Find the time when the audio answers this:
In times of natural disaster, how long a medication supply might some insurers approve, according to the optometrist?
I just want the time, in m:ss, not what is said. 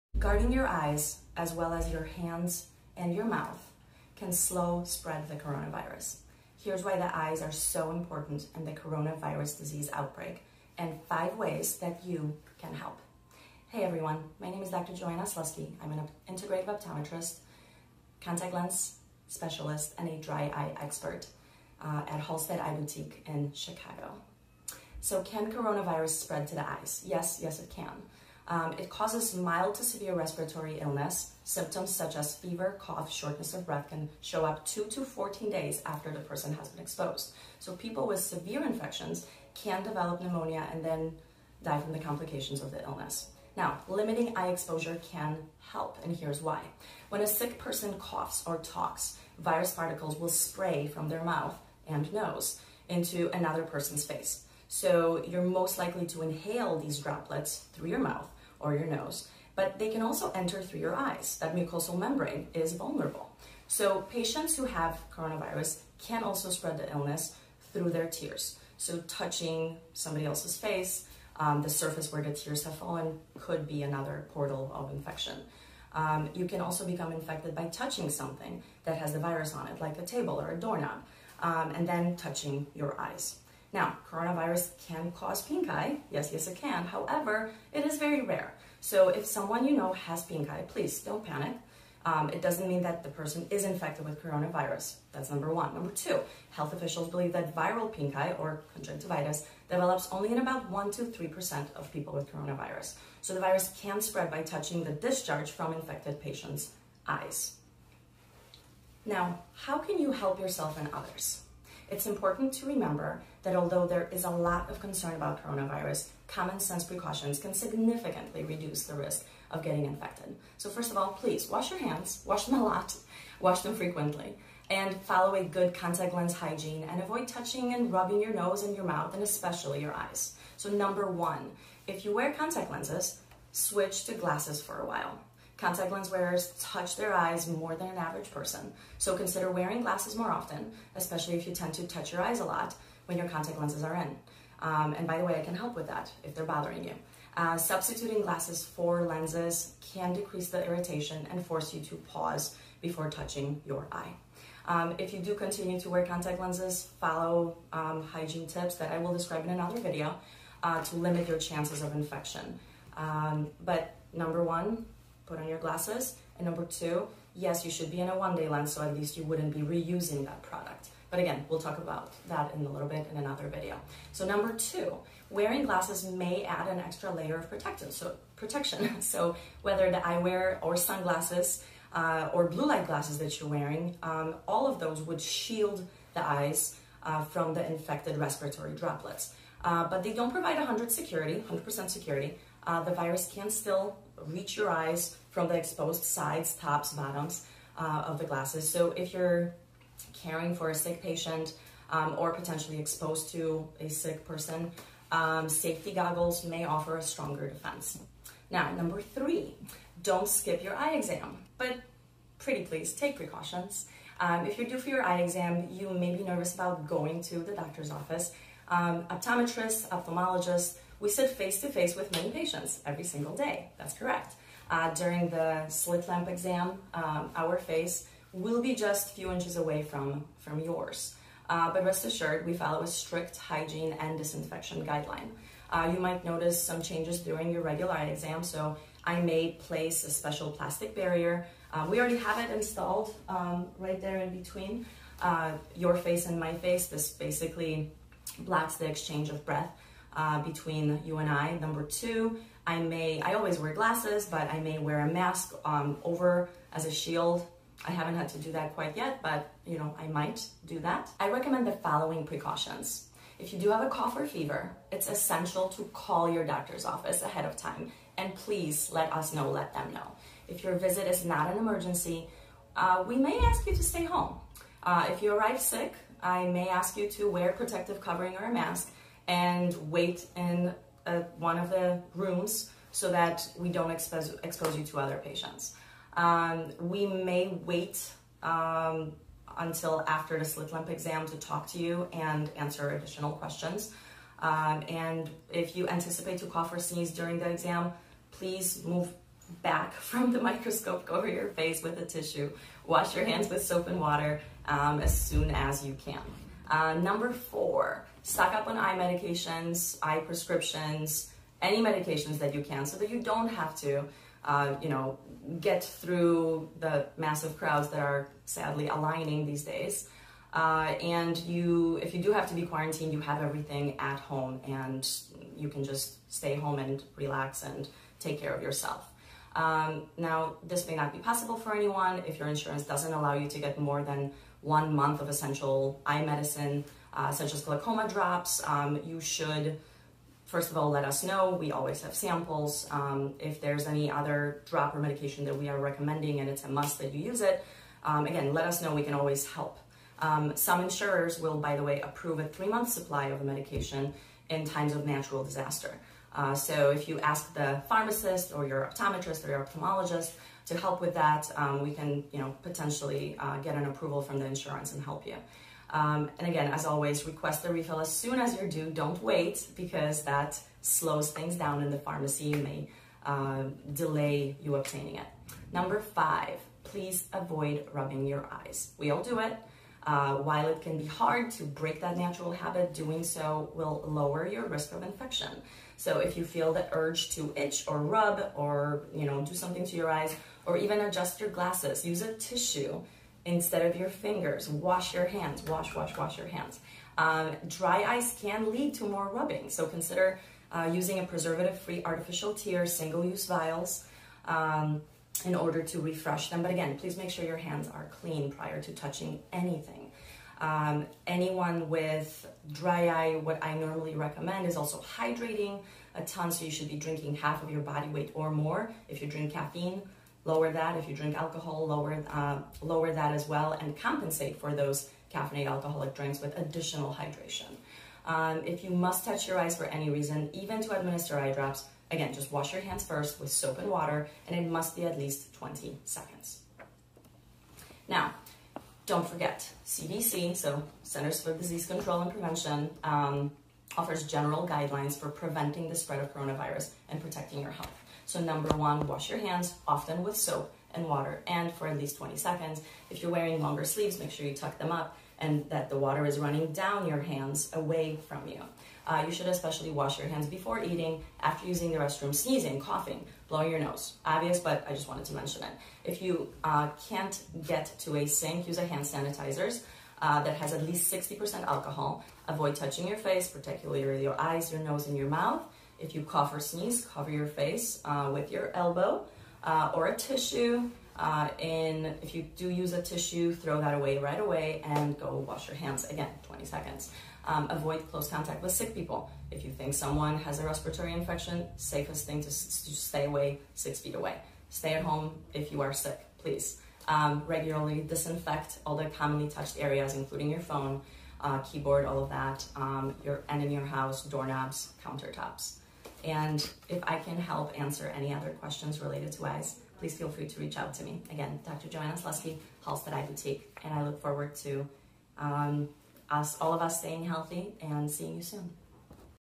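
5:52.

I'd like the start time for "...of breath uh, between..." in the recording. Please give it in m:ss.
4:09.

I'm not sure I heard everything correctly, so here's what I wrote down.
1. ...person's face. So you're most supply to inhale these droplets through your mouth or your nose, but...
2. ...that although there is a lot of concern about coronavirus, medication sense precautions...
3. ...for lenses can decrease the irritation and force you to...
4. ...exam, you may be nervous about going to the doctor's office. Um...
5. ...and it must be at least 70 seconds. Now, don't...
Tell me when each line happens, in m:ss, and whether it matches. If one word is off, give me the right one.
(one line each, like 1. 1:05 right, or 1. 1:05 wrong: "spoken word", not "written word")
1. 0:53 wrong: "likely", not "supply"
2. 1:53 wrong: "common", not "medication"
3. 2:28 right
4. 3:35 right
5. 7:14 wrong: "20", not "70".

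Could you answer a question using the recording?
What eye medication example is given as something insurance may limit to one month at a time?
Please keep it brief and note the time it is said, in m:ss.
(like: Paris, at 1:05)
glaucoma drops, at 5:37.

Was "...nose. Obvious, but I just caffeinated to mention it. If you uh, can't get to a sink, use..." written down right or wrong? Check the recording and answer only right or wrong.
wrong.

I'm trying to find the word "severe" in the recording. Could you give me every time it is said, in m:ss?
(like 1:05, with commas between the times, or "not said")
0:29, 0:38.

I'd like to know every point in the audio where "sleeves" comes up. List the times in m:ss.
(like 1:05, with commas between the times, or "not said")
7:33.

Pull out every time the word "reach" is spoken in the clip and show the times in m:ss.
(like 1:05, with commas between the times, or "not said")
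3:14, 8:30.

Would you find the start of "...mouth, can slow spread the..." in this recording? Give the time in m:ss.
0:03.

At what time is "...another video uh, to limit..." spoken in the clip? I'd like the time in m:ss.
2:39.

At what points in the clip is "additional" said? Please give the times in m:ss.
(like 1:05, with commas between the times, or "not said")
4:52, 7:06.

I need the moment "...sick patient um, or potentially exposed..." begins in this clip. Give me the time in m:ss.
3:20.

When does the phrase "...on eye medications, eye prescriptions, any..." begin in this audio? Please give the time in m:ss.
5:08.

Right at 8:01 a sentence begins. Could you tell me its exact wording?
Uh, and if you do use a tissue, throw that away right away and go wash your hands again, 20 seconds.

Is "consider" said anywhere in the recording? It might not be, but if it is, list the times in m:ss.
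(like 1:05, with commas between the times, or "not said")
2:19, 6:39.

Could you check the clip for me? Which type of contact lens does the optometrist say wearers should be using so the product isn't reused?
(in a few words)
one-day lens.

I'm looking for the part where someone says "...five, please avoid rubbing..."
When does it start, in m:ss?
6:15.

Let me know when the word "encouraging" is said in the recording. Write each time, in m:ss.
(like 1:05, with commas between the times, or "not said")
not said.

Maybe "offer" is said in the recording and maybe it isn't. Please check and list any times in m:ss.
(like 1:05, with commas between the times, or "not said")
3:26, 7:23.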